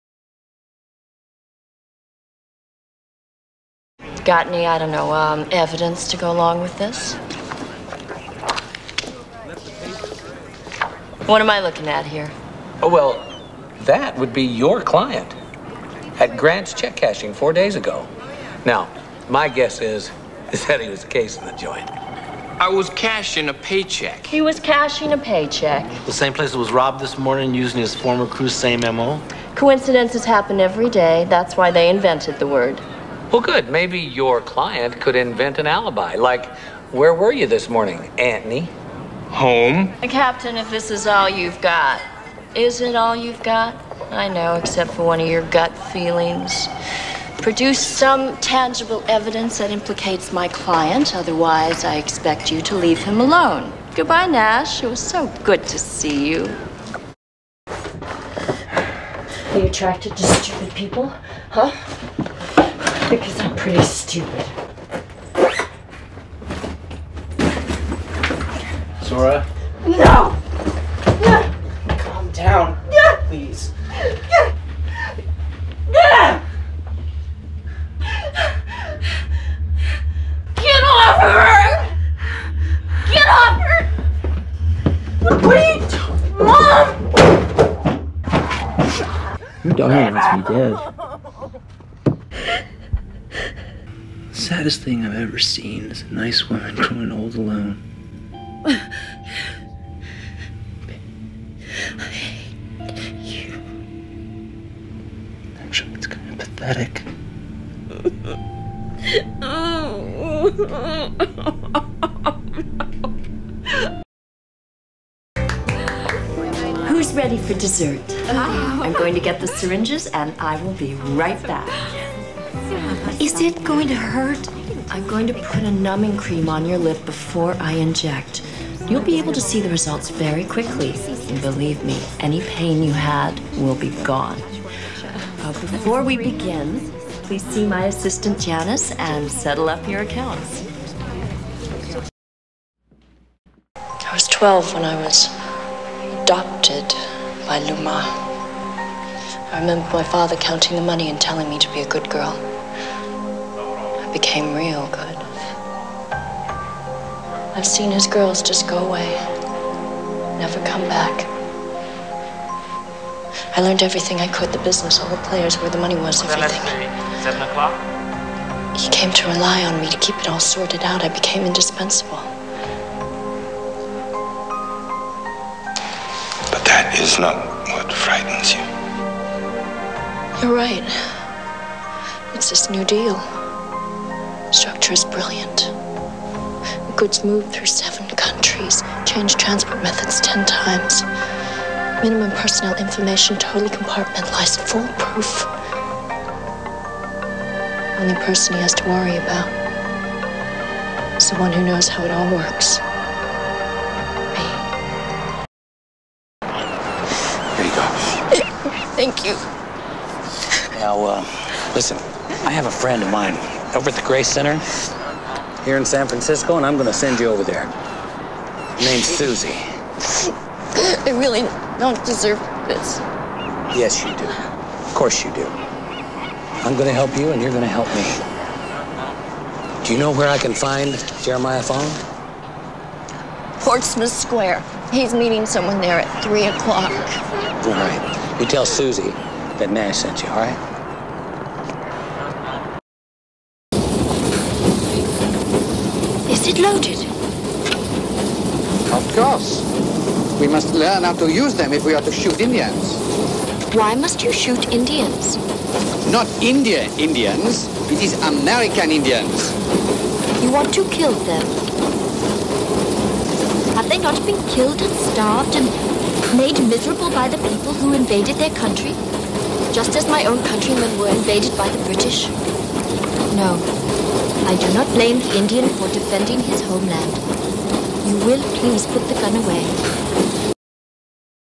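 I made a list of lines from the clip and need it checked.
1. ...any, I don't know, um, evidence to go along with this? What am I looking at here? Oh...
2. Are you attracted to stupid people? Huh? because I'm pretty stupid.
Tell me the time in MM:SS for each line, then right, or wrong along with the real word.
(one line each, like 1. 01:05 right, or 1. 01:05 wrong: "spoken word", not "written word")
1. 00:04 right
2. 00:57 right.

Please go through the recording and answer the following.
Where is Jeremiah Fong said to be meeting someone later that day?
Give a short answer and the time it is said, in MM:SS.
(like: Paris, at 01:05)
Portsmouth Square, at 03:53.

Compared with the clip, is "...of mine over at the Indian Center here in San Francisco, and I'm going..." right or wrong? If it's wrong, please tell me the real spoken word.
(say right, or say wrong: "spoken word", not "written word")
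wrong: "Gray", not "Indian".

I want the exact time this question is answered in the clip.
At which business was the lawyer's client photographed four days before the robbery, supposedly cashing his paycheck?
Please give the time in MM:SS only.
00:16.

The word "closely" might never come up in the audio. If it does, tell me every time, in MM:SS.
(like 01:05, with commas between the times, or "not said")
not said.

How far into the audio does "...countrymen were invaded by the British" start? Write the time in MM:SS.
04:30.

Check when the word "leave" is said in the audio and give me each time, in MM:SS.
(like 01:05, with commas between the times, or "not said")
00:52.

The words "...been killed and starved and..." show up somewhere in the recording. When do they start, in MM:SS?
04:24.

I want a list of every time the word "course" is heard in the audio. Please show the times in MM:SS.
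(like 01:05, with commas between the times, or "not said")
03:44, 04:09.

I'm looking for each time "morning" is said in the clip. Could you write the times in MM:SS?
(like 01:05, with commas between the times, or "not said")
00:27, 00:37.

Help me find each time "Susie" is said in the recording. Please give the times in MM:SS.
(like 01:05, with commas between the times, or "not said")
03:39, 03:58.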